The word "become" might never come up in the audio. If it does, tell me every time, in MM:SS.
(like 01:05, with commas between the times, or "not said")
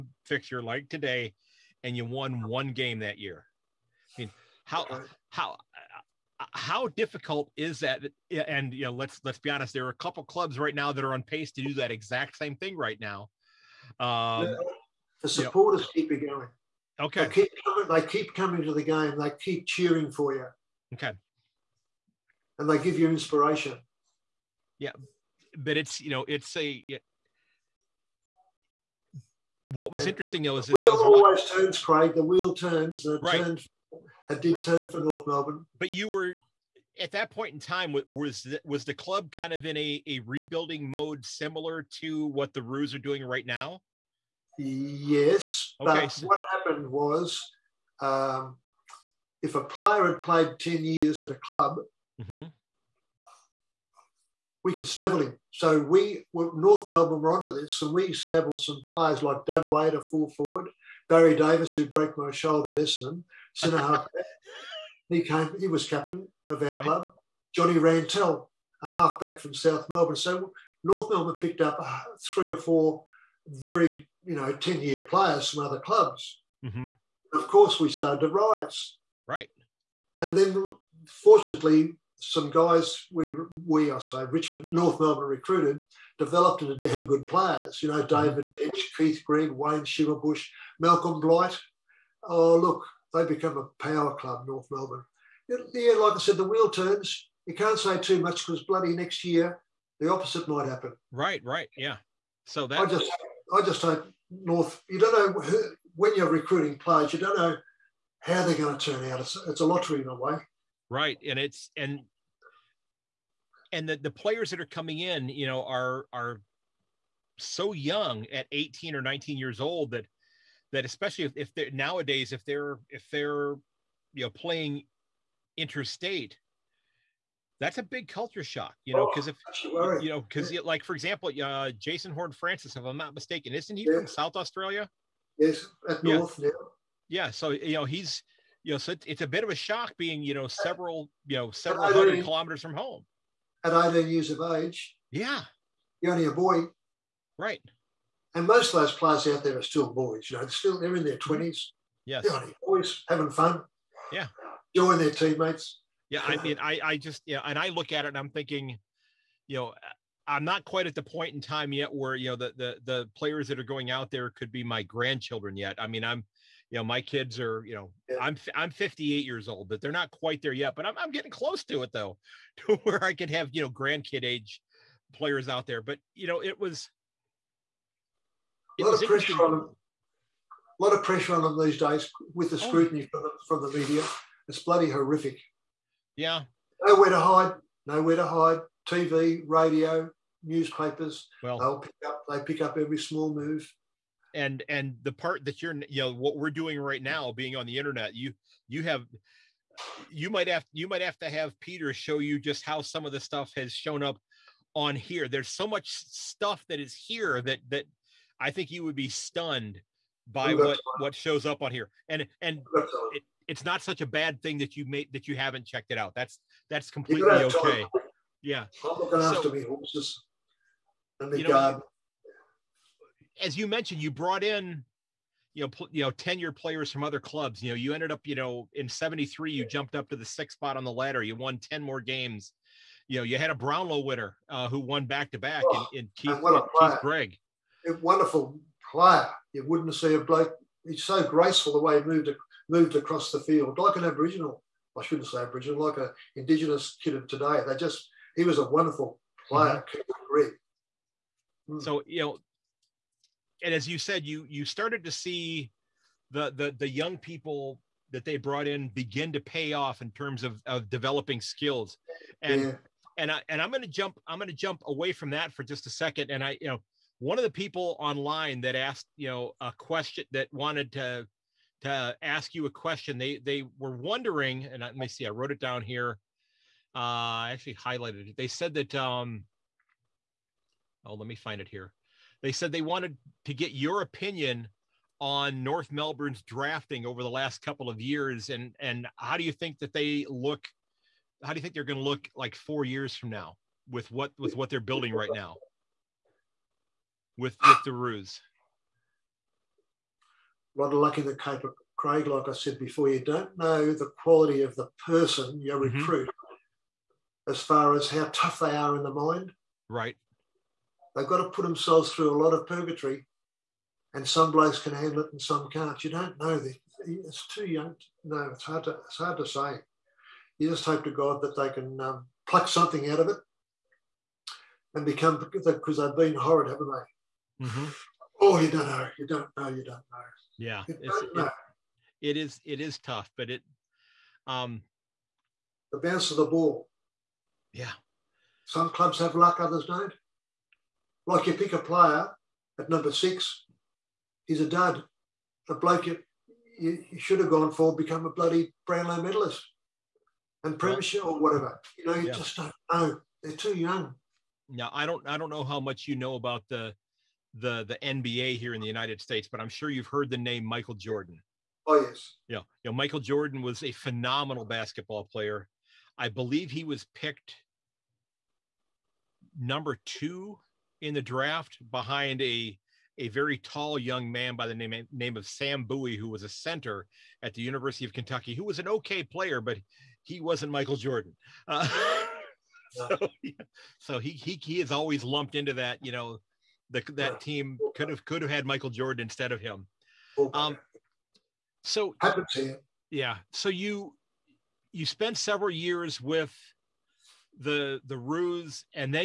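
01:33, 05:25, 05:47.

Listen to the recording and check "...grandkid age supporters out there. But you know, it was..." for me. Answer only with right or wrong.
wrong.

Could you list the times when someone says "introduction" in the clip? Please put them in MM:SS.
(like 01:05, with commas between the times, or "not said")
not said.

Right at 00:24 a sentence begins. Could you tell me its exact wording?
Yeah, but it's you know it's a what was and interesting though is, is wheel always watching.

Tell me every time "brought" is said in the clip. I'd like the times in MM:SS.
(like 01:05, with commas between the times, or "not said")
03:44, 04:18.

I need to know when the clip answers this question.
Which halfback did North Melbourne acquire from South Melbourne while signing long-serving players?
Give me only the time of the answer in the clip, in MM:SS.
01:07.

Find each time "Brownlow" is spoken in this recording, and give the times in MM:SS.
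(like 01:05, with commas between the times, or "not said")
03:53, 05:48.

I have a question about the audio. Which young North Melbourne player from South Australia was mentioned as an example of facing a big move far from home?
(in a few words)
Jason Horne-Francis.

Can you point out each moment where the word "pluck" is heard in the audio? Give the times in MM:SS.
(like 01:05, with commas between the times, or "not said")
05:22.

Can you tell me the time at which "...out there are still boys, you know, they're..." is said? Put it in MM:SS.
02:29.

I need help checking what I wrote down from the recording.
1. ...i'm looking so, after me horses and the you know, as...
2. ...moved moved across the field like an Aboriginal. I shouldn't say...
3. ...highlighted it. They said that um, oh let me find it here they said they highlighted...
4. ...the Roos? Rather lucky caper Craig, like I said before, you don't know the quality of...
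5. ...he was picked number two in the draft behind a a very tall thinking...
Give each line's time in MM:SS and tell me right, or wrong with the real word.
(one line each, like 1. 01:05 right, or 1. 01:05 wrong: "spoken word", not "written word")
1. 03:38 right
2. 04:02 right
3. 04:37 wrong: "wanted", not "highlighted"
4. 04:57 right
5. 06:06 wrong: "young", not "thinking".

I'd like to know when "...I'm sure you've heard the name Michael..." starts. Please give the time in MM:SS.
05:59.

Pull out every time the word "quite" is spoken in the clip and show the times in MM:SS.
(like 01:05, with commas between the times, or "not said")
02:40, 02:50.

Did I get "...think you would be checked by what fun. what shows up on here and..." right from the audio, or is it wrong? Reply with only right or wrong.
wrong.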